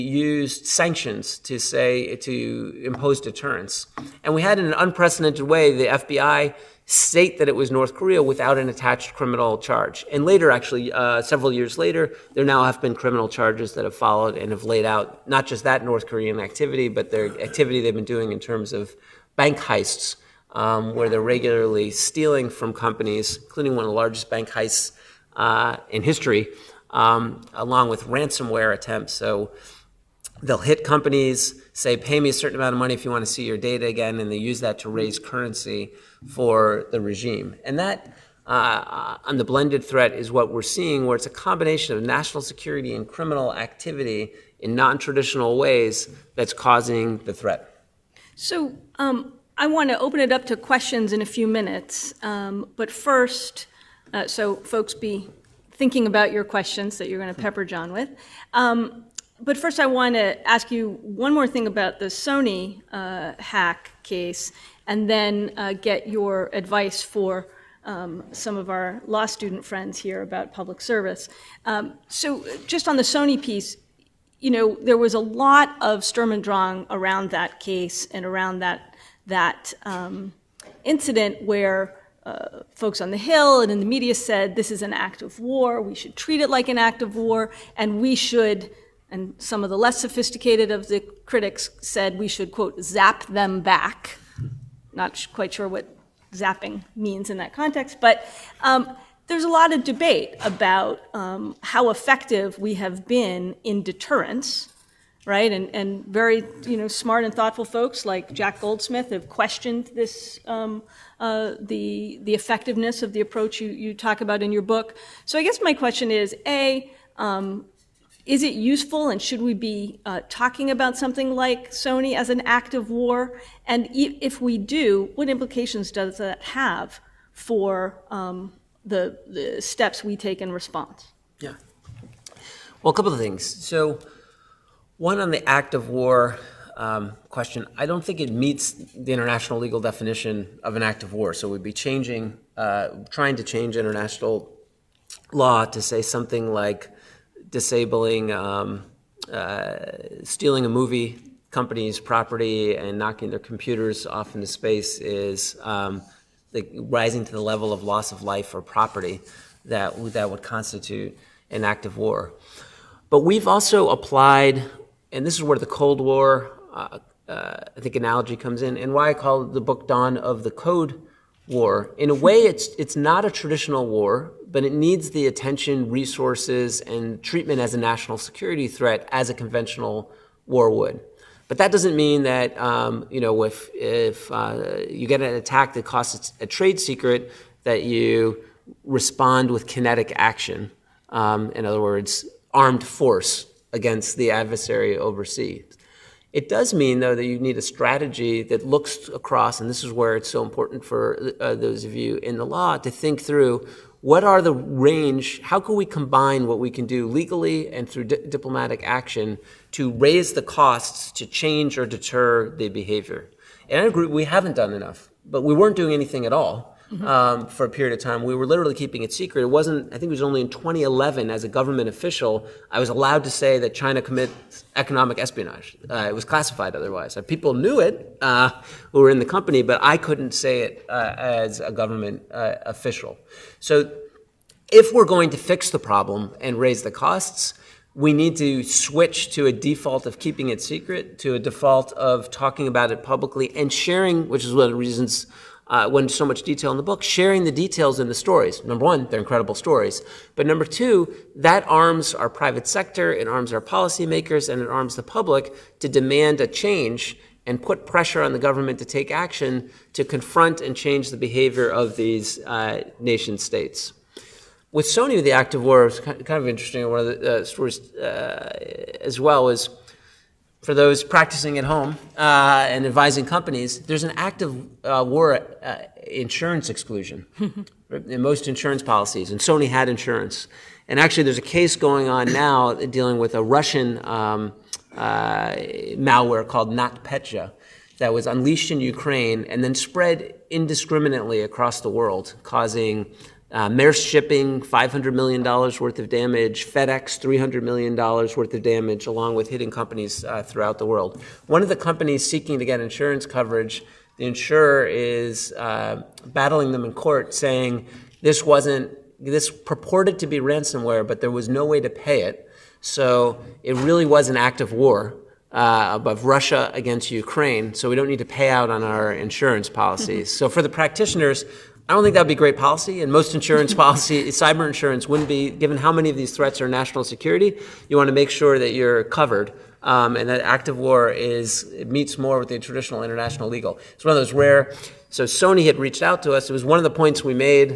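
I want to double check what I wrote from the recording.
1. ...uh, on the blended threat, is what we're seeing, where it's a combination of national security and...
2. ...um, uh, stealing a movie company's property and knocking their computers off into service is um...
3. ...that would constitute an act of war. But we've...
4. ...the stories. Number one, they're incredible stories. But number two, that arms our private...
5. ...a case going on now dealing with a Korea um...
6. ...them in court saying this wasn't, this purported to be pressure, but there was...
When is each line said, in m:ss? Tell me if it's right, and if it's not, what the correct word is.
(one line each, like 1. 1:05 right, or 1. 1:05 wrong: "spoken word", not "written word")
1. 0:38 right
2. 2:28 wrong: "space", not "service"
3. 2:40 right
4. 4:08 right
5. 4:41 wrong: "Russian", not "Korea"
6. 5:06 wrong: "ransomware", not "pressure".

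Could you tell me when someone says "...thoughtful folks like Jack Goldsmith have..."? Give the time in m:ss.
1:47.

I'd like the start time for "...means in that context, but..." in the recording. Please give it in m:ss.
1:36.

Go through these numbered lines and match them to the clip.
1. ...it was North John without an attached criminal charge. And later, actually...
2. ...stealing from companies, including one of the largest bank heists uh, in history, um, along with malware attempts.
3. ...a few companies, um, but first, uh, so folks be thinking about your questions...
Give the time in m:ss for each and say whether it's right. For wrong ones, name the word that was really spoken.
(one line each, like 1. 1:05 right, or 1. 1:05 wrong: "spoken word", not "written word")
1. 0:07 wrong: "Korea", not "John"
2. 0:21 wrong: "ransomware", not "malware"
3. 0:51 wrong: "minutes", not "companies".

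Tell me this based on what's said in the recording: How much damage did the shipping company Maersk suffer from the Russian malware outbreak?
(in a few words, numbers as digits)
$500 million.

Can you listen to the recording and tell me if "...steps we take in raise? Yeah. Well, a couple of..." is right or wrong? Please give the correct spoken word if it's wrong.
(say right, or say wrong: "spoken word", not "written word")
wrong: "response", not "raise".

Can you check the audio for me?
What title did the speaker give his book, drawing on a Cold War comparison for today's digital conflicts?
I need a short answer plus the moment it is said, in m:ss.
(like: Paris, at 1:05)
Dawn of the Code War, at 2:49.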